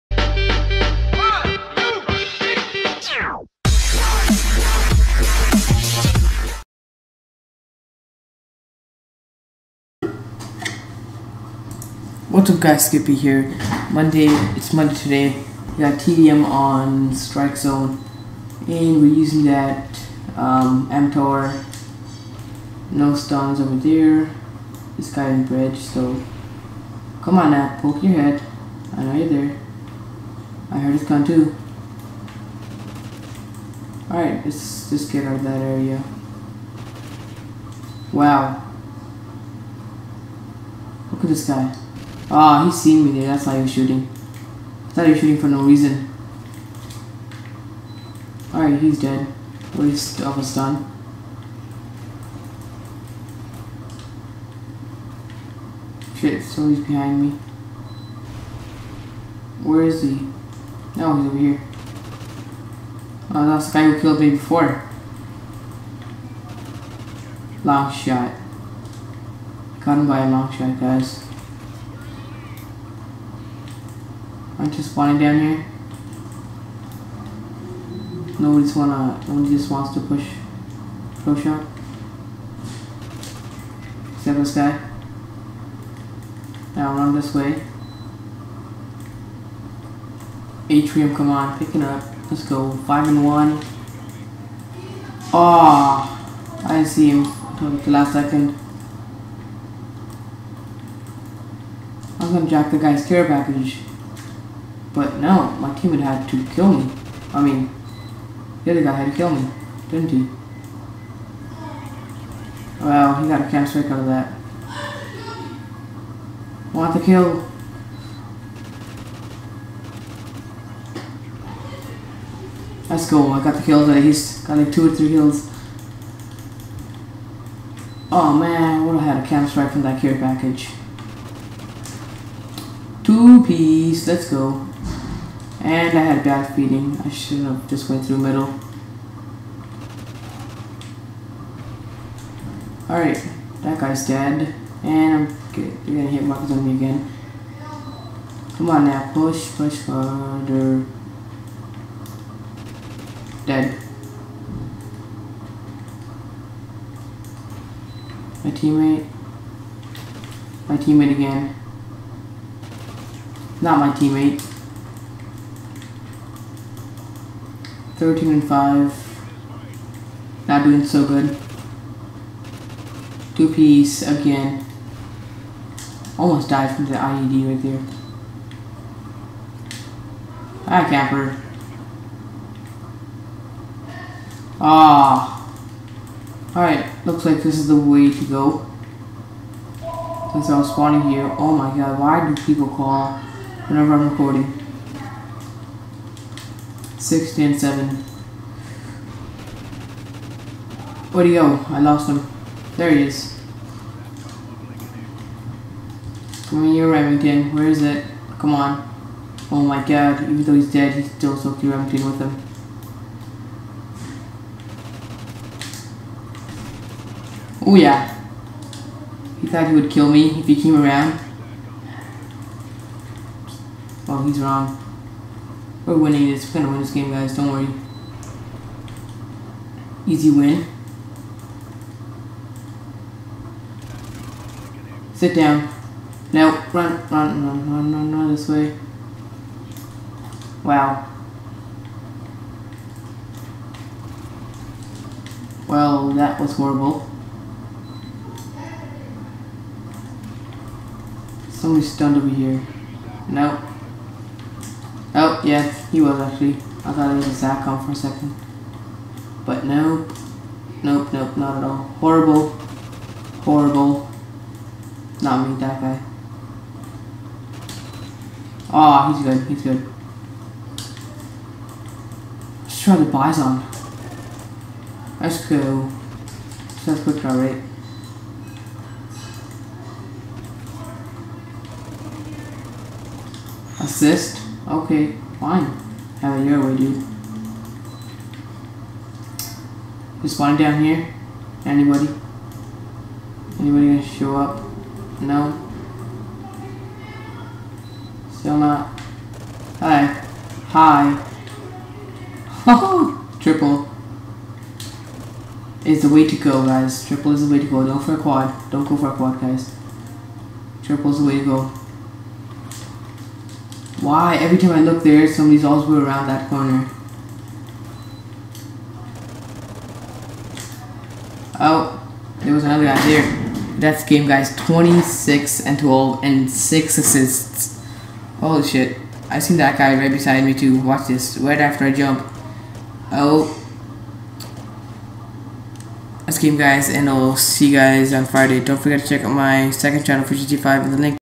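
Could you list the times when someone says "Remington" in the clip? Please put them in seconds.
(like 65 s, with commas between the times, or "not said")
206 s, 211 s.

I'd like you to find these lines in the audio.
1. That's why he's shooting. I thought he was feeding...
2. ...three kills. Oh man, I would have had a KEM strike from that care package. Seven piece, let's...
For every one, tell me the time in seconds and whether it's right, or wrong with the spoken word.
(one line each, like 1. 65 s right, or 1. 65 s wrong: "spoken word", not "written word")
1. 43 s wrong: "shooting", not "feeding"
2. 124 s wrong: "Two", not "Seven".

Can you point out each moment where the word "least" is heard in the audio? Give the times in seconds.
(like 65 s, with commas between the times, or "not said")
49 s, 123 s.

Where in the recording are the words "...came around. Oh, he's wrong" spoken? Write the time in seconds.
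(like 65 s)
220 s.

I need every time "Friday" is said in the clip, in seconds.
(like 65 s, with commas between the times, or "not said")
338 s.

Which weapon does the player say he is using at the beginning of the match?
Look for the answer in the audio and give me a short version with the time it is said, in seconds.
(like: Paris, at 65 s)
MTAR, at 20 s.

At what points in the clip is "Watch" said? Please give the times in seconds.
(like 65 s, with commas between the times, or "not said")
330 s.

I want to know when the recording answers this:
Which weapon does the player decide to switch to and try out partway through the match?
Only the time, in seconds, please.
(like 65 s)
273 s.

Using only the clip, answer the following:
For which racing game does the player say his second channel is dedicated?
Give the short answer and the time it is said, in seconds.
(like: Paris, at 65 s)
GT5, at 340 s.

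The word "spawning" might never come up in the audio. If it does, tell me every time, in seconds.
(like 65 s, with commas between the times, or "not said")
74 s, 190 s, 290 s.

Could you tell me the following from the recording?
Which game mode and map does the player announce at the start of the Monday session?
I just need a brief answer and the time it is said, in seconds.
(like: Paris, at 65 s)
TDM on Strike Zone, at 15 s.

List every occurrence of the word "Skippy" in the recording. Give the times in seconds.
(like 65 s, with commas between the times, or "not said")
12 s.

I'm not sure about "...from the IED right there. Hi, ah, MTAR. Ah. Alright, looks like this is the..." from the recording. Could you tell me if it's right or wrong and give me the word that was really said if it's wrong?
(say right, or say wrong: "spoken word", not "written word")
wrong: "Capper", not "MTAR".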